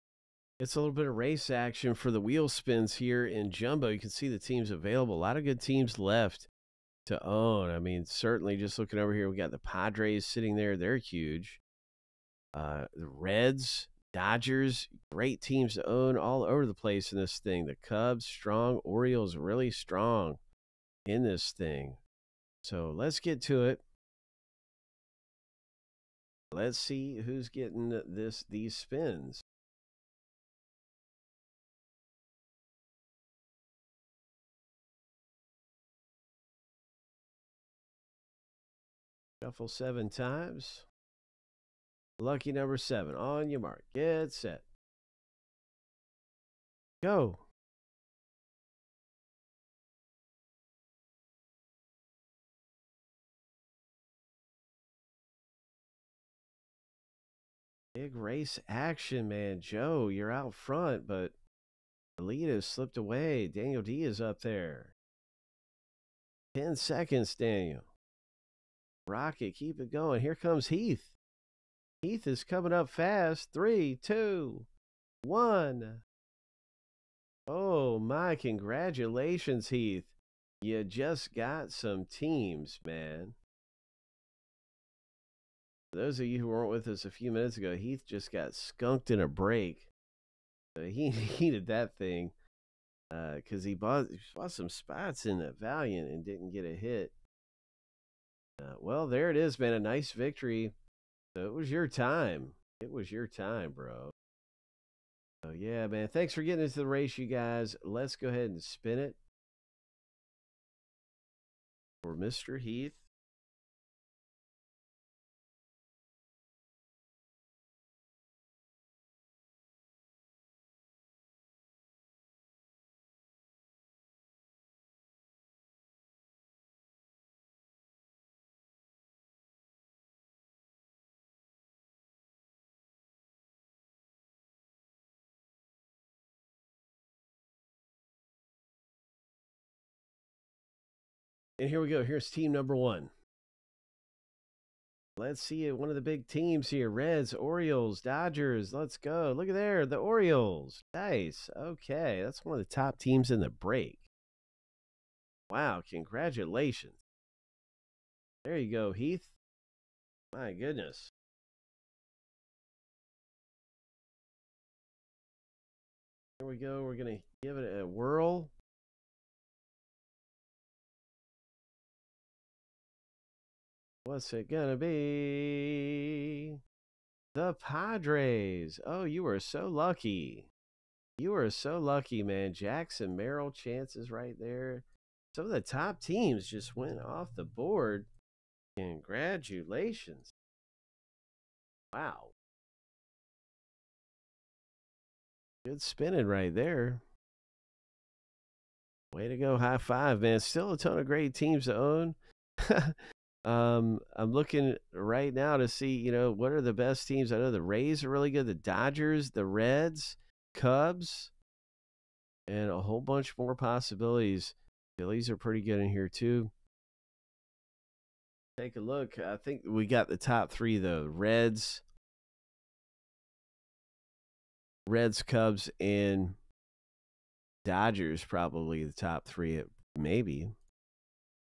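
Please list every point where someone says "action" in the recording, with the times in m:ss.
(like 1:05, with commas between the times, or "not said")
0:01, 0:58.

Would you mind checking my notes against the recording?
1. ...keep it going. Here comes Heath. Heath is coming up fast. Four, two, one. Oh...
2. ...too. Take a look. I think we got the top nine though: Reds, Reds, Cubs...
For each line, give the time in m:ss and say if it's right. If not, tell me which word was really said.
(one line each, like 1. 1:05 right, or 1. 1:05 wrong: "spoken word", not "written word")
1. 1:09 wrong: "Three", not "Four"
2. 3:36 wrong: "three", not "nine".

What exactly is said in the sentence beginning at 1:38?
Uh, well, there it is, man.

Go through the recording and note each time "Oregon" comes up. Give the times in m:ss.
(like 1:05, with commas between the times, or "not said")
not said.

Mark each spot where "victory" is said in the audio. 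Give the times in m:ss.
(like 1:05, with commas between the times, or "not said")
1:40.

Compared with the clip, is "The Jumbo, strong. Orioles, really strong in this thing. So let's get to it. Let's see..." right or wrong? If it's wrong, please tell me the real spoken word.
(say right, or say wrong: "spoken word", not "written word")
wrong: "Cubs", not "Jumbo".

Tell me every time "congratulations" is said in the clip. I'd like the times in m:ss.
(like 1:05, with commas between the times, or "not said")
1:18, 2:35, 3:08.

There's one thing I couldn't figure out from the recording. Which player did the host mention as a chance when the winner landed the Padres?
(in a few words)
Jackson Merrill.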